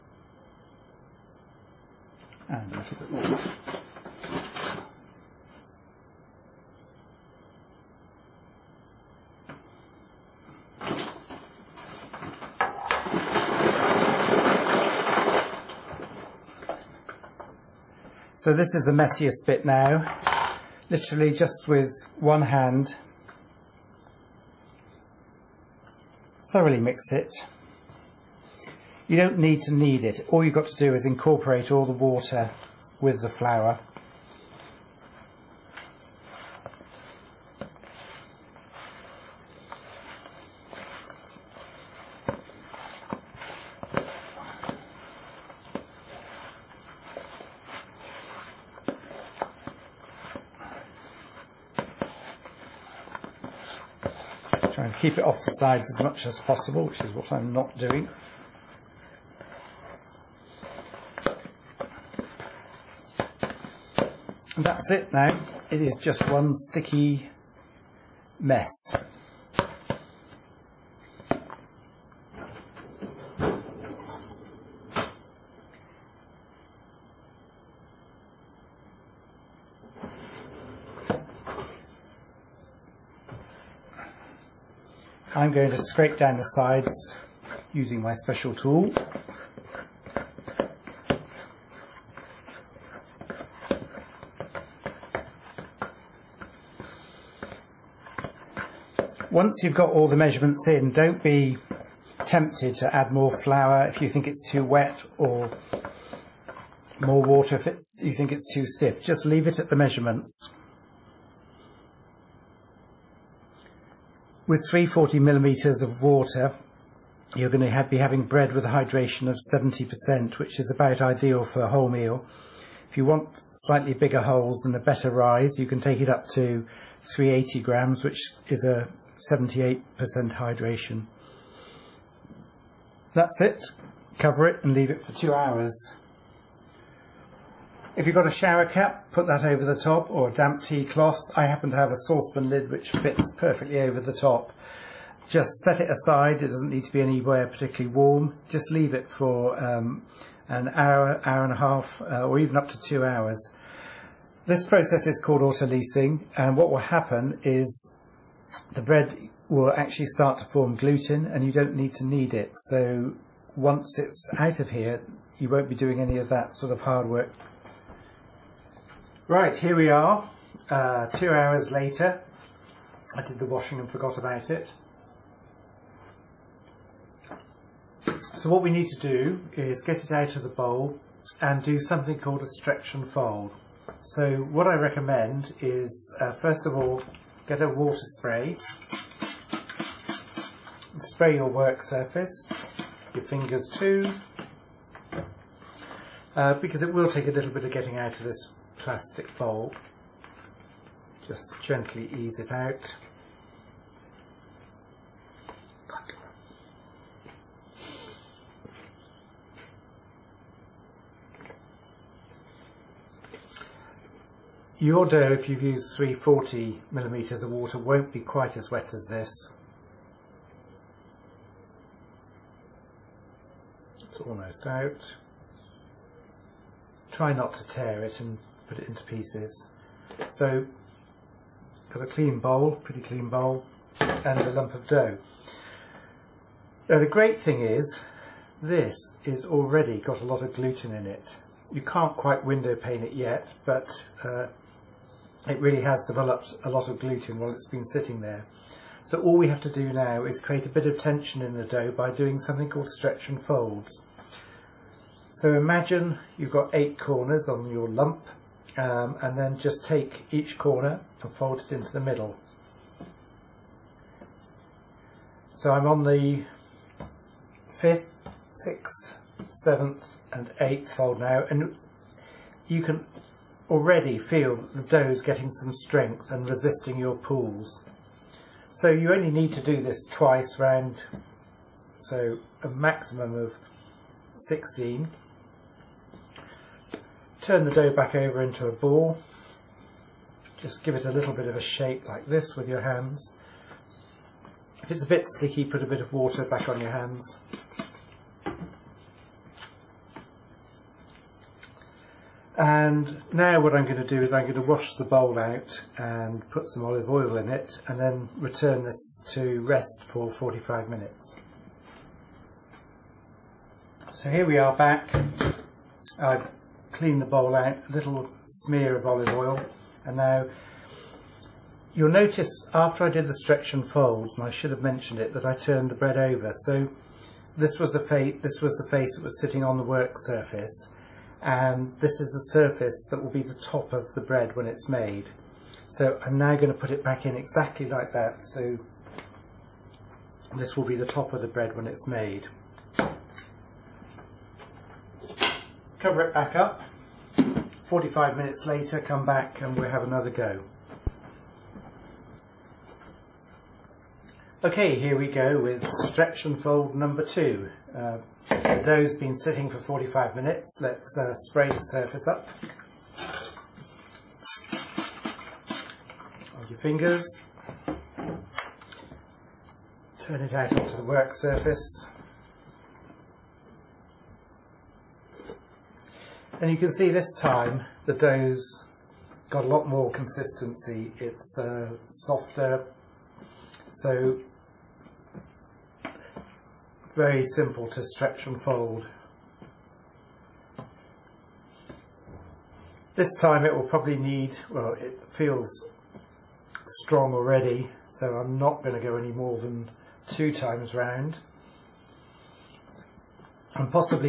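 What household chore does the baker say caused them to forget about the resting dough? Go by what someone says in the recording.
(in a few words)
the washing.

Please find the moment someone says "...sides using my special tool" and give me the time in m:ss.
1:26.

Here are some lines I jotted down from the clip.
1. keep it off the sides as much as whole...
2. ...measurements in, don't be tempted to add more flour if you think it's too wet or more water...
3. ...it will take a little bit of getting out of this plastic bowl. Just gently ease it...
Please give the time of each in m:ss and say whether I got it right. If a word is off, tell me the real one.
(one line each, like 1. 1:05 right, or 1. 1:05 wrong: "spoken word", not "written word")
1. 0:55 wrong: "possible", not "whole"
2. 1:40 right
3. 3:16 right.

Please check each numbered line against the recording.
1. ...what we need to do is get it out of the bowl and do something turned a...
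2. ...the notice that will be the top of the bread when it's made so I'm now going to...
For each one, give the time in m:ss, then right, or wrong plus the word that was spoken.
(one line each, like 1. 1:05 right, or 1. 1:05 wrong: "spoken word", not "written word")
1. 2:58 wrong: "called", not "turned"
2. 5:32 wrong: "surface", not "notice".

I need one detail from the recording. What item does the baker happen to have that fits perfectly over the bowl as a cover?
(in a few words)
saucepan lid.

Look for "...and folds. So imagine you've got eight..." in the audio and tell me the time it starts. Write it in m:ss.
4:13.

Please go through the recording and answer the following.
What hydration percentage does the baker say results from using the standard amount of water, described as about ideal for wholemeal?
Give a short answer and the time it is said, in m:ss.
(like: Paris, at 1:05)
70%, at 1:59.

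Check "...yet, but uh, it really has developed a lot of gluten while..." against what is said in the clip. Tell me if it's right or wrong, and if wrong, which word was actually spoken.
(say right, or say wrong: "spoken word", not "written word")
right.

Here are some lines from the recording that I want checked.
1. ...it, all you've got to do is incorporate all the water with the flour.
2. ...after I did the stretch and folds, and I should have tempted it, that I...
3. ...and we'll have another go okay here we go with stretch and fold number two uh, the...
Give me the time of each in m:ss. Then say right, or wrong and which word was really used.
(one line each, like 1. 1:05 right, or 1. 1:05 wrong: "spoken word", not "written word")
1. 0:30 right
2. 5:22 wrong: "mentioned", not "tempted"
3. 5:49 right.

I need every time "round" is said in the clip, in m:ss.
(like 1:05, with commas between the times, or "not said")
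4:40, 6:40.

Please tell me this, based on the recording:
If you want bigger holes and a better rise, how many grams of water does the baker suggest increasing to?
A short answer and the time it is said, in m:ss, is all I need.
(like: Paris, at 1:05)
380 grams, at 2:07.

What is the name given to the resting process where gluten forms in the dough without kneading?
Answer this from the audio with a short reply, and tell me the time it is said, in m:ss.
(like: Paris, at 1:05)
autolysing, at 2:35.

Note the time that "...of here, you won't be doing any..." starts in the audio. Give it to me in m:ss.
2:44.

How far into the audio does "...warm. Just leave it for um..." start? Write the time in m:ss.
2:27.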